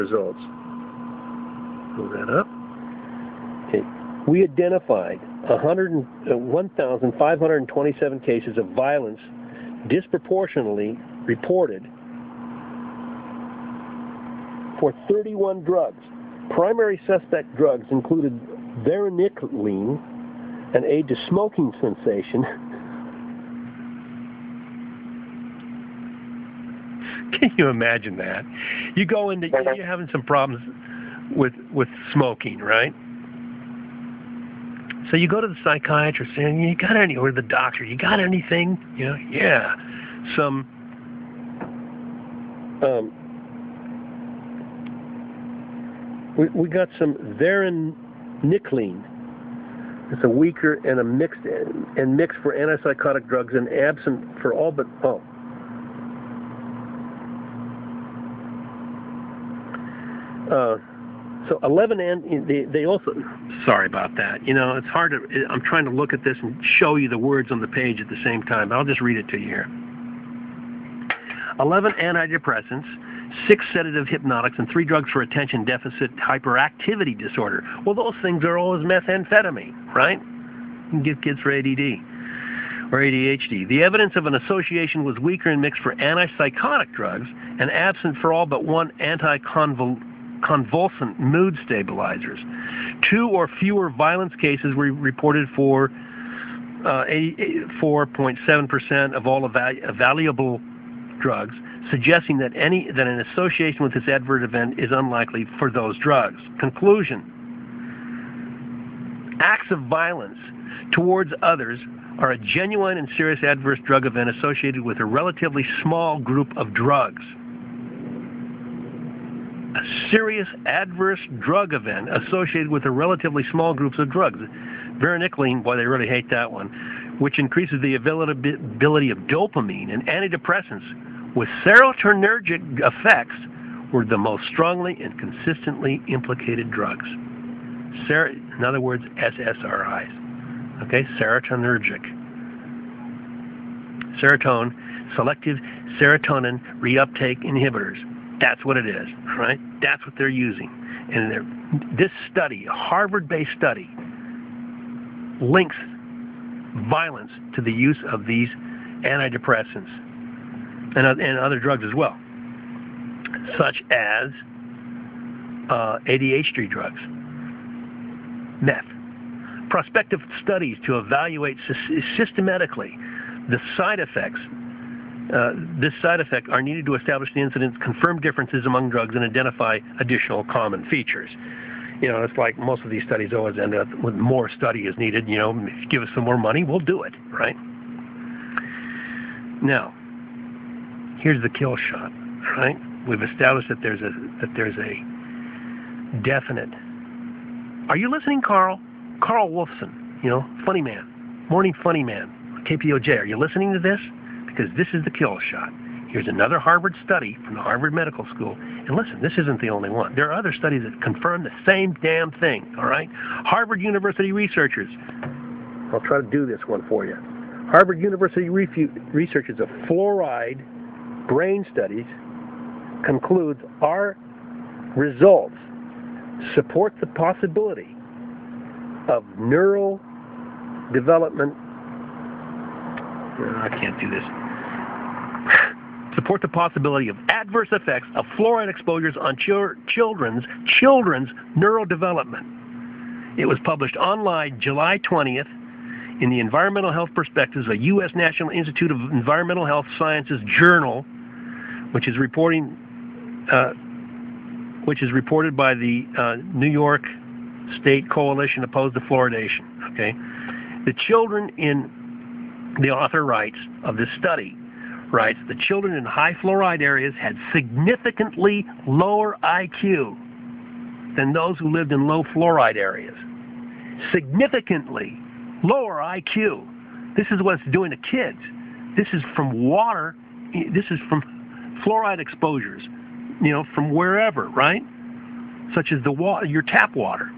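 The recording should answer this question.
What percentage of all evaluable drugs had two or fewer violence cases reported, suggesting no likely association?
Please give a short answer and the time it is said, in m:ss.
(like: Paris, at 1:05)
84.7%, at 1:37.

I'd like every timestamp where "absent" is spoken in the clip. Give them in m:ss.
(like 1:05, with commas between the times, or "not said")
0:53, 1:27.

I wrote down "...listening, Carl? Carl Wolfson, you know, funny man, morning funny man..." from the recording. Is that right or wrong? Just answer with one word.
right.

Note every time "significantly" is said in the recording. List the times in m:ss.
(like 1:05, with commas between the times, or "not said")
4:27, 4:34.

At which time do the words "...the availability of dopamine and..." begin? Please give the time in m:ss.
2:07.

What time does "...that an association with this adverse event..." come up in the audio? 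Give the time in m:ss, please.
1:42.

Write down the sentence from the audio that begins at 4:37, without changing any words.
This is what it's doing to kids.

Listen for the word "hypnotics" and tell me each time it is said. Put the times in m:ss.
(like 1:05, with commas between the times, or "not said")
1:14.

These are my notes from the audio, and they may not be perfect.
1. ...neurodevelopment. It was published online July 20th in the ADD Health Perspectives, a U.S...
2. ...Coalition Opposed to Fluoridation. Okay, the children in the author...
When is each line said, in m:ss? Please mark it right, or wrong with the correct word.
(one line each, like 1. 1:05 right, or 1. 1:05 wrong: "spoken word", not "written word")
1. 4:01 wrong: "Environmental", not "ADD"
2. 4:18 right.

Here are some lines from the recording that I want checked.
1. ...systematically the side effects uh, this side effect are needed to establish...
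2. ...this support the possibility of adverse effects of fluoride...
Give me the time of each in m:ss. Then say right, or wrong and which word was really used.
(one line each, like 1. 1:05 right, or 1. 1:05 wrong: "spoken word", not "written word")
1. 2:52 right
2. 3:54 right.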